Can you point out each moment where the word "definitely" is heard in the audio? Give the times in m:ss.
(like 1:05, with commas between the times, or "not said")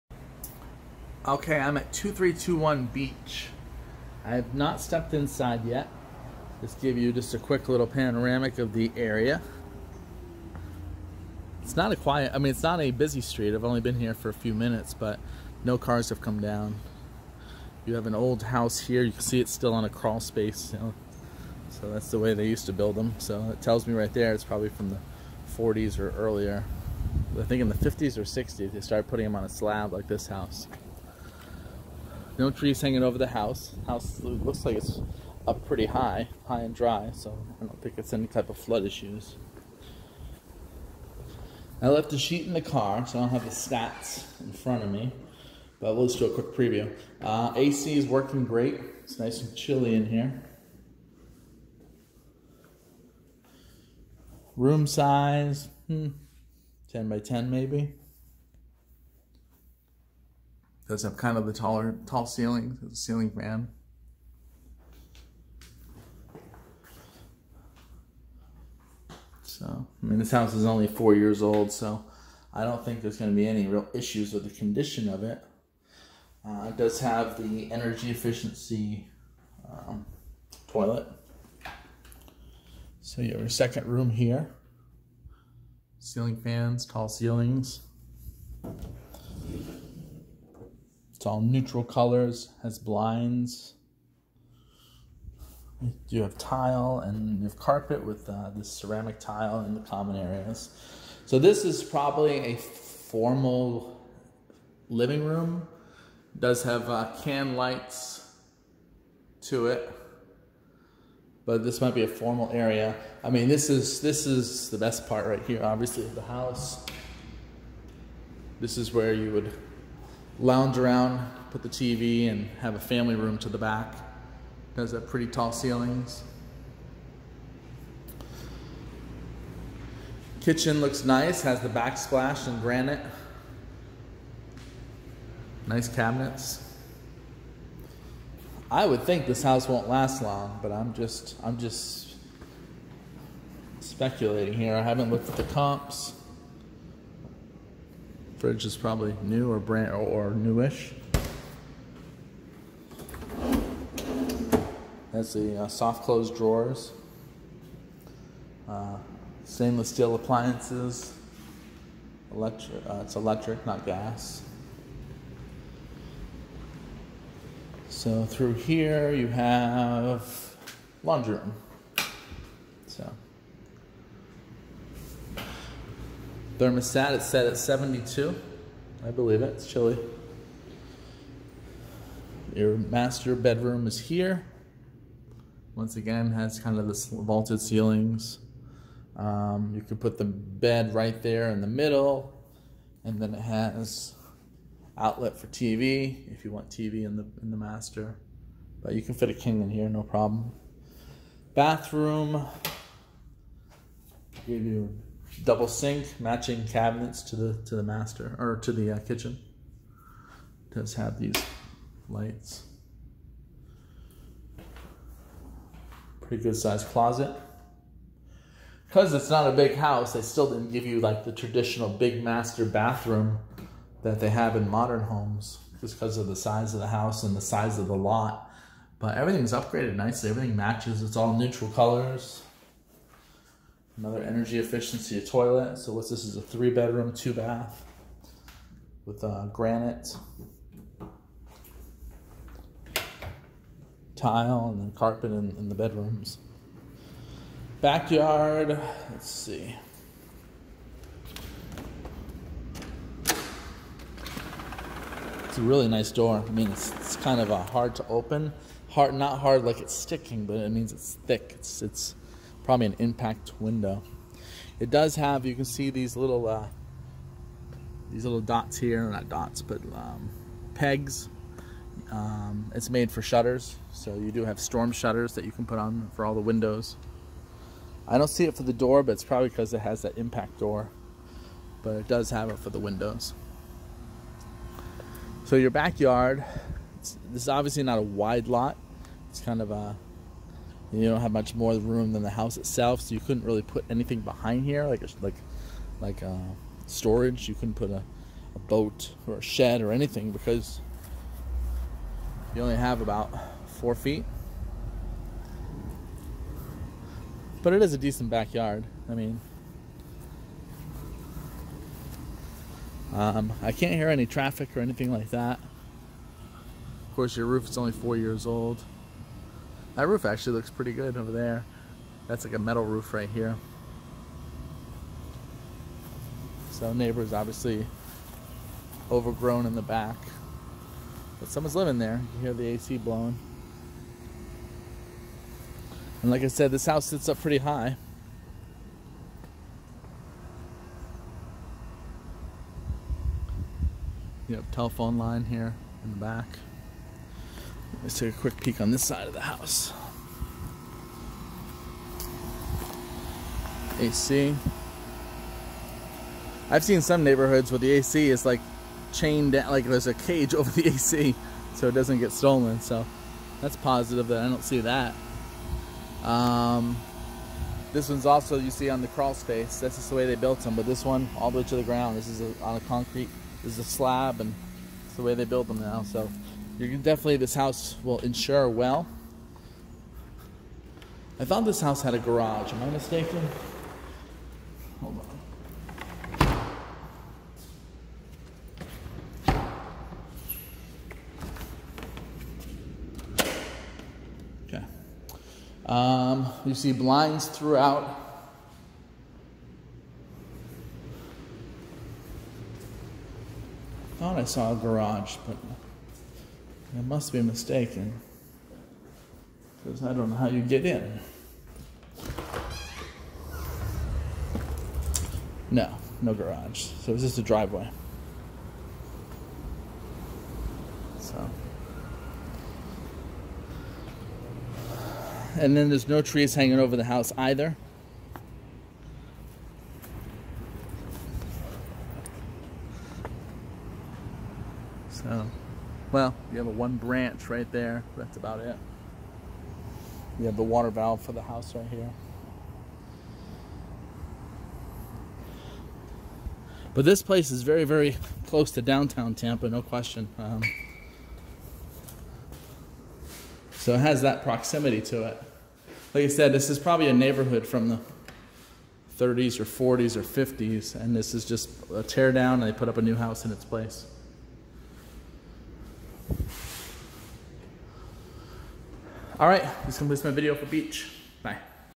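6:17.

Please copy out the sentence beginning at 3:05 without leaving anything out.
Once again, has kind of this vaulted ceilings.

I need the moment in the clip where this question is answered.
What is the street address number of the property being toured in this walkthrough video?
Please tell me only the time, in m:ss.
0:01.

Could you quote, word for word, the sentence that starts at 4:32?
Um, it's made for shutters, so you do have storm shutters that you can put on for all the windows.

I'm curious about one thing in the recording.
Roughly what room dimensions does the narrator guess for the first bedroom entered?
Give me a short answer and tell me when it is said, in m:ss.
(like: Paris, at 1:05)
10 by 10, at 0:56.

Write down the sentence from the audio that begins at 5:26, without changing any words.
So neighbor's obviously overgrown in the back.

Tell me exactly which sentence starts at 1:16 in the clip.
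Uh, it does have the energy efficiency um, toilet.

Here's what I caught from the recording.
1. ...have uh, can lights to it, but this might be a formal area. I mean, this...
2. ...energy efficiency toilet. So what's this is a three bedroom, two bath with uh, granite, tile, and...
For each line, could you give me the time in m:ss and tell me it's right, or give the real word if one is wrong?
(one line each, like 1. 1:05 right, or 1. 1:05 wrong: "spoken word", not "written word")
1. 1:46 right
2. 3:54 right.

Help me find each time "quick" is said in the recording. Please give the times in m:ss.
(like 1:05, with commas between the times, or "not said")
0:07, 0:46, 5:48.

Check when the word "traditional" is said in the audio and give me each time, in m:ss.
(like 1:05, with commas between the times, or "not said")
3:41.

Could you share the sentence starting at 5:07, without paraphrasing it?
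But it is a decent backyard.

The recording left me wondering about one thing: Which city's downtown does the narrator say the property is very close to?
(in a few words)
Tampa.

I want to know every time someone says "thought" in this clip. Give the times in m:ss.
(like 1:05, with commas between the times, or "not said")
6:21, 6:44.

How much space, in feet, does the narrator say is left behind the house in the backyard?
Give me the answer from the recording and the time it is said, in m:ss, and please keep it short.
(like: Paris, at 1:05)
4 feet, at 5:03.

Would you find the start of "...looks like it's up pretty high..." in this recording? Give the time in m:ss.
0:34.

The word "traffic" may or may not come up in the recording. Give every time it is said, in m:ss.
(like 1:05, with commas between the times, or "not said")
5:14.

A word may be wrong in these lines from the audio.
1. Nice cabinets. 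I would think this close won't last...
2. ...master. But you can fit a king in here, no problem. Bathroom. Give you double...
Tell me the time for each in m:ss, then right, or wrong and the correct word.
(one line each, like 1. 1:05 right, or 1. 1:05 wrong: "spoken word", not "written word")
1. 2:15 wrong: "house", not "close"
2. 3:17 right.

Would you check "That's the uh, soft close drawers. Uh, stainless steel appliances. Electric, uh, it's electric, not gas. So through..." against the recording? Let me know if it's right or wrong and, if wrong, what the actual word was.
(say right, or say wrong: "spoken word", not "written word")
right.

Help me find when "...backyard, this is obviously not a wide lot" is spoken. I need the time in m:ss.
4:45.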